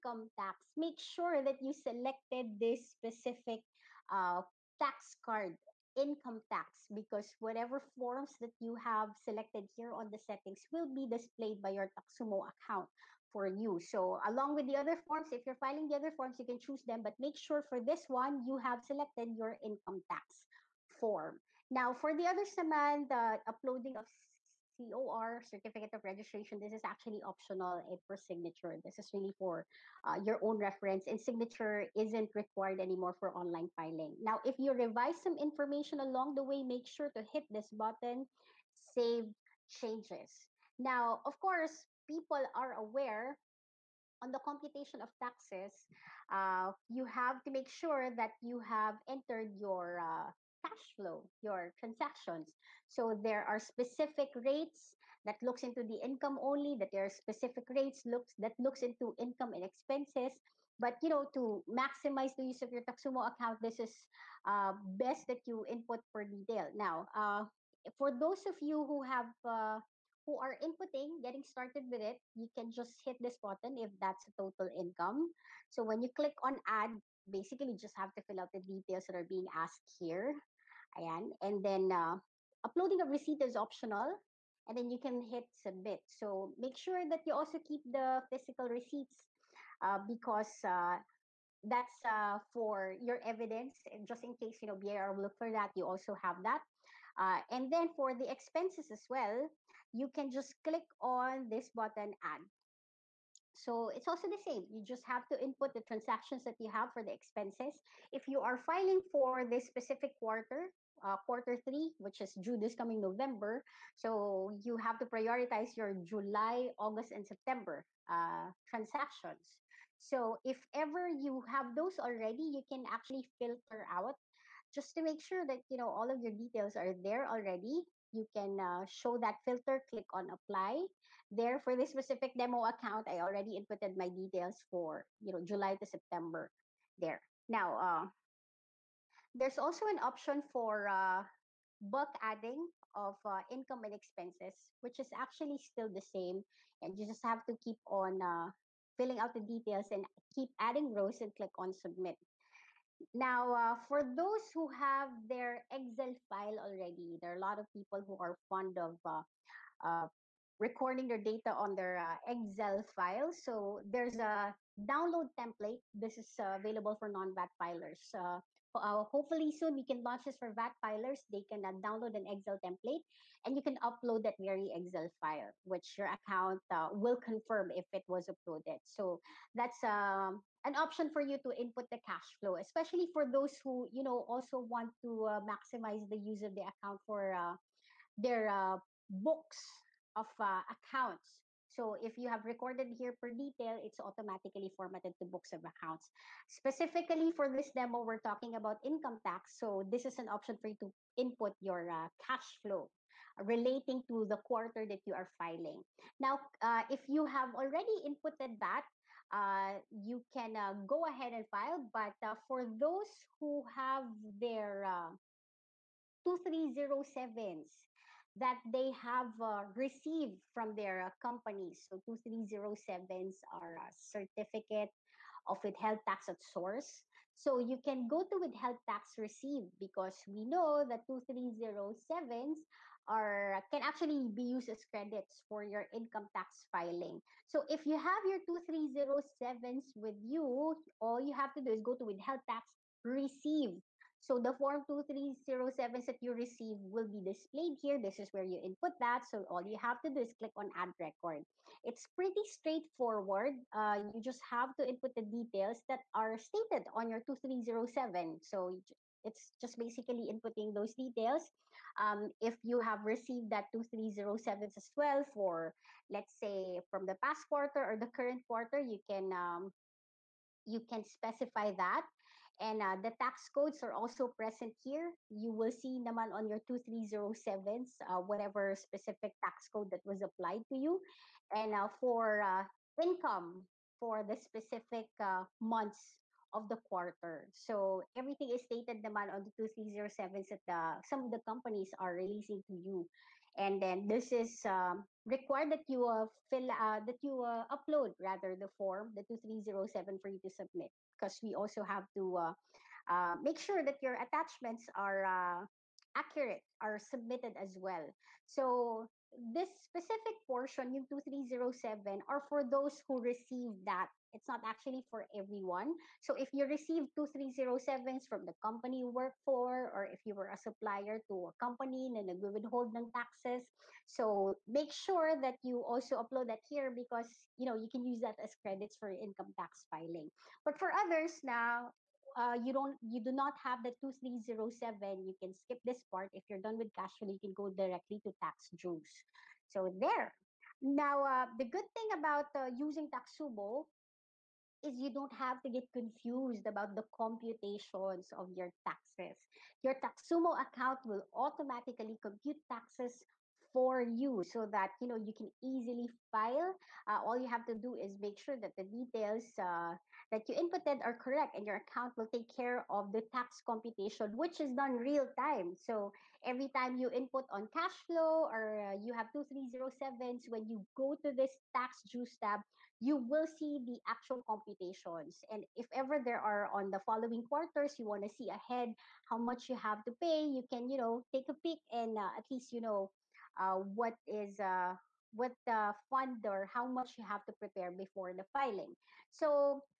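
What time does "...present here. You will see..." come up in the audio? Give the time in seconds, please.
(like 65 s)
274 s.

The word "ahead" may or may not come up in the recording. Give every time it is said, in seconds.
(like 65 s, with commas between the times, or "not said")
211 s, 378 s.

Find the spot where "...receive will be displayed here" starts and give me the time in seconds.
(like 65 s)
246 s.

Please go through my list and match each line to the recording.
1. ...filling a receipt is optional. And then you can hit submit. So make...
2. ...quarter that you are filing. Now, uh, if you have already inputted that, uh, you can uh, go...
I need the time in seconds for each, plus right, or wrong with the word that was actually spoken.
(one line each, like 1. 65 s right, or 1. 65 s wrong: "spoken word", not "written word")
1. 82 s wrong: "uploading", not "filling"
2. 204 s right.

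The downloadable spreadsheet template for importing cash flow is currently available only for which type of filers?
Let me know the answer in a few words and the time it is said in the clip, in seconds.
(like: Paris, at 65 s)
non-VAT filers, at 167 s.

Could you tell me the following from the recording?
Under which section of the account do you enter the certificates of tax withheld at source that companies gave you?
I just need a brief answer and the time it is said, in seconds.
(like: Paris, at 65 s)
withheld tax received, at 228 s.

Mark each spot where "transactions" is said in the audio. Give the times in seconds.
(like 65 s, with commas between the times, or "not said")
51 s, 105 s, 118 s.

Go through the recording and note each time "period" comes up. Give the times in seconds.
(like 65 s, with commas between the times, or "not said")
not said.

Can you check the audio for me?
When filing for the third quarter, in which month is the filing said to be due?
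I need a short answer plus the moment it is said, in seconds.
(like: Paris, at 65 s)
November, at 112 s.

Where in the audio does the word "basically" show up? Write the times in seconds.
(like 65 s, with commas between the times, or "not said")
77 s, 259 s.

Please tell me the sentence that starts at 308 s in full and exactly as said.
So this specific portion, you 2307, are for those who receive that it's not actually for everyone.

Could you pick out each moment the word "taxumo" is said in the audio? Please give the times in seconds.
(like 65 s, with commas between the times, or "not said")
11 s, 62 s, 343 s, 349 s.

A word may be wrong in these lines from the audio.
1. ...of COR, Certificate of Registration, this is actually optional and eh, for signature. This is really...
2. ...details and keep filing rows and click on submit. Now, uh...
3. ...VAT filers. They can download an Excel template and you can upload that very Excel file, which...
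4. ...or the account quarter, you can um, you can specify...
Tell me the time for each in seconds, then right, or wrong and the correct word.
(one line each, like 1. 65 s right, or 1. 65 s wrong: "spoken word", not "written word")
1. 23 s right
2. 149 s wrong: "adding", not "filing"
3. 170 s right
4. 267 s wrong: "current", not "account".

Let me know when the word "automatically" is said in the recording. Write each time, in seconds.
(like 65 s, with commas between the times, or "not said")
193 s, 351 s.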